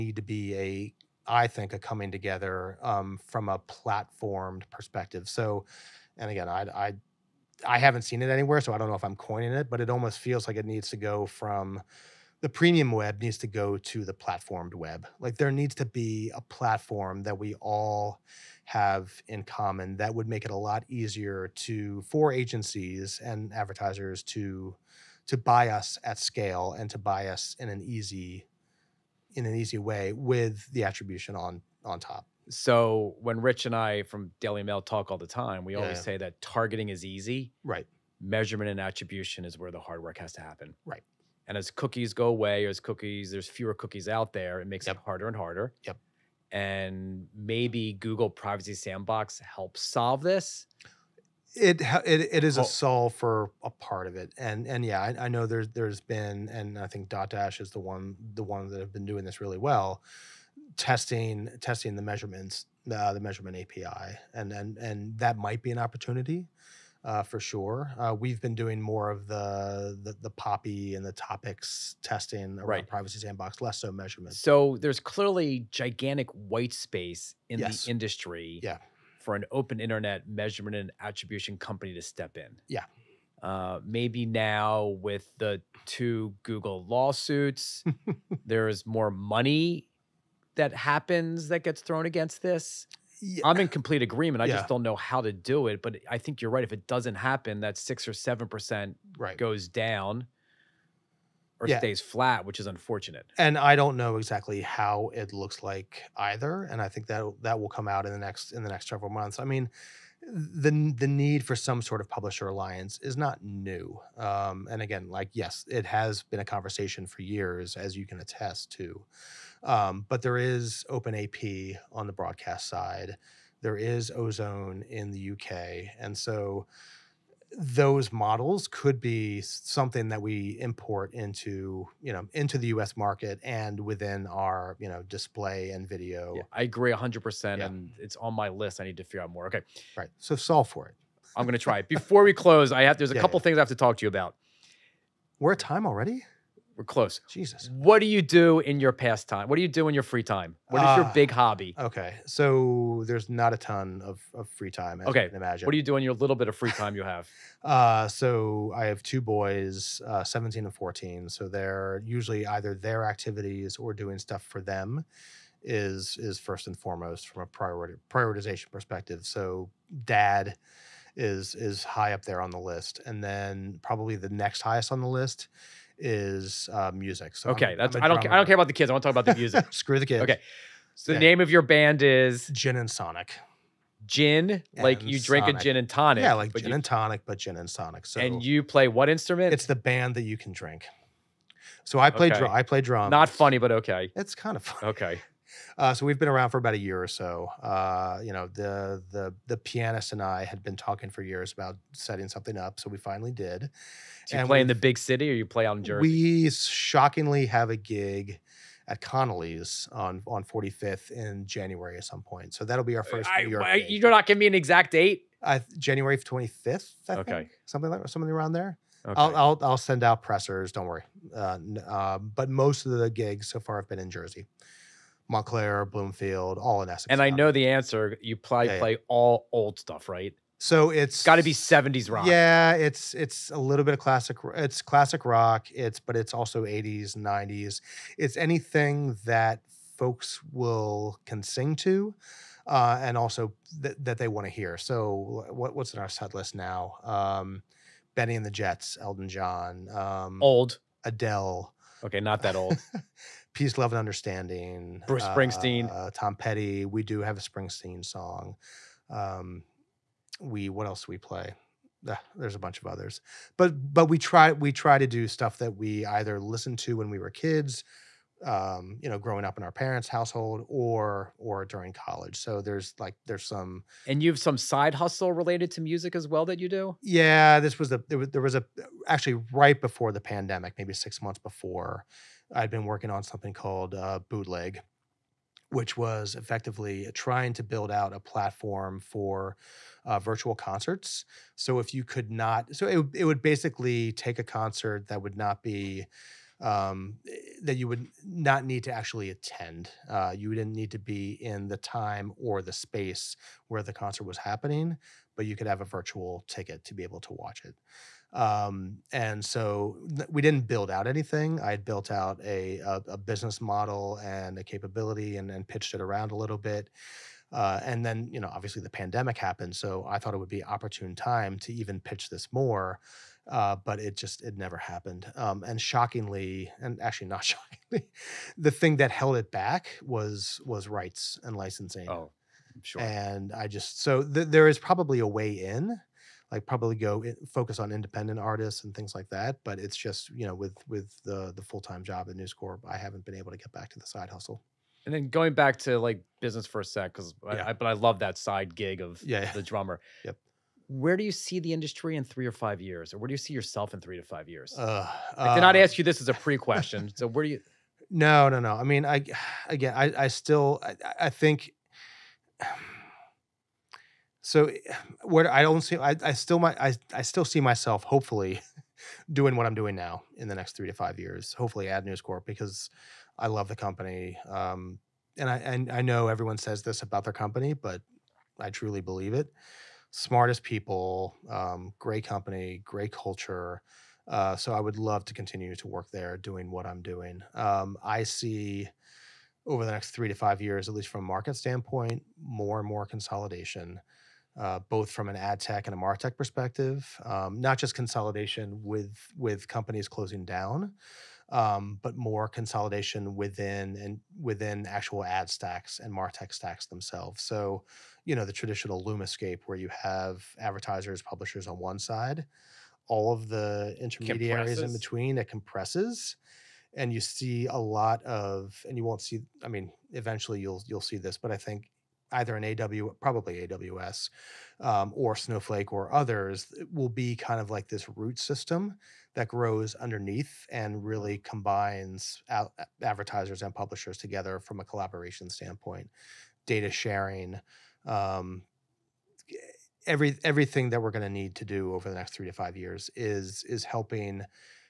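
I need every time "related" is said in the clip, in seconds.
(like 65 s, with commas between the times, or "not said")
275 s.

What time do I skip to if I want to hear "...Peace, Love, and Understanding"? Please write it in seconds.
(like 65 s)
253 s.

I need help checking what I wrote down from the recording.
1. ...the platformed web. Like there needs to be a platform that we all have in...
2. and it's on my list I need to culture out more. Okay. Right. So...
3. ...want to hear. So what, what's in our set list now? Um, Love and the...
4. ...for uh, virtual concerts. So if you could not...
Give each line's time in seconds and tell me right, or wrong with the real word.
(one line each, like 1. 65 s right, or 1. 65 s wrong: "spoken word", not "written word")
1. 14 s right
2. 137 s wrong: "figure", not "culture"
3. 244 s wrong: "Benny", not "Love"
4. 288 s right.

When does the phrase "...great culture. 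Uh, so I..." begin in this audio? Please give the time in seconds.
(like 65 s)
382 s.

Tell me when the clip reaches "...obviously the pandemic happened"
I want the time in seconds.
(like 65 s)
318 s.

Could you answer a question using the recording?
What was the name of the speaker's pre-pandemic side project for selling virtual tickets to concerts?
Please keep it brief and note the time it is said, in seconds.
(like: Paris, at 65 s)
Bootleg, at 284 s.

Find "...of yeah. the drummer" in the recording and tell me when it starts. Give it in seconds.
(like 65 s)
348 s.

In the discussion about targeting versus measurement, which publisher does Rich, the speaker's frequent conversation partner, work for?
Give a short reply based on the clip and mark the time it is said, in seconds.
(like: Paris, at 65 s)
Daily Mail, at 34 s.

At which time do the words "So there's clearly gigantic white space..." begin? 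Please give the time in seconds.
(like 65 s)
74 s.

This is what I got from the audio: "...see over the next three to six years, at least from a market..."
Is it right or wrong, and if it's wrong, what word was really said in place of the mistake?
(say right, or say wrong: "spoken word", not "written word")
wrong: "five", not "six".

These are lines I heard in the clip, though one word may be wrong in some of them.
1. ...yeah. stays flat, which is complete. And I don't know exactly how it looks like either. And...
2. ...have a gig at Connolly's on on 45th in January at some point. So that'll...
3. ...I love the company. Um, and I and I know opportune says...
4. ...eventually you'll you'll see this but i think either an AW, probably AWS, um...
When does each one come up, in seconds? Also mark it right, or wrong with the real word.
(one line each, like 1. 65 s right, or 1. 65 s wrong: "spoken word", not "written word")
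1. 101 s wrong: "unfortunate", not "complete"
2. 207 s right
3. 373 s wrong: "everyone", not "opportune"
4. 420 s right.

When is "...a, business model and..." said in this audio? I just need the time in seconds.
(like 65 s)
313 s.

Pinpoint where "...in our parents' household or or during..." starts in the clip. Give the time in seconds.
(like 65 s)
269 s.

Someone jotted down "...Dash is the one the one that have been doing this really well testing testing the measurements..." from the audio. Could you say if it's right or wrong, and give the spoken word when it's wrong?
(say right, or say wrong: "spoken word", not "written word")
right.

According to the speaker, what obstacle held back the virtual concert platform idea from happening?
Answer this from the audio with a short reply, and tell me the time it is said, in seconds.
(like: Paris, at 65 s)
Rights and licensing, at 330 s.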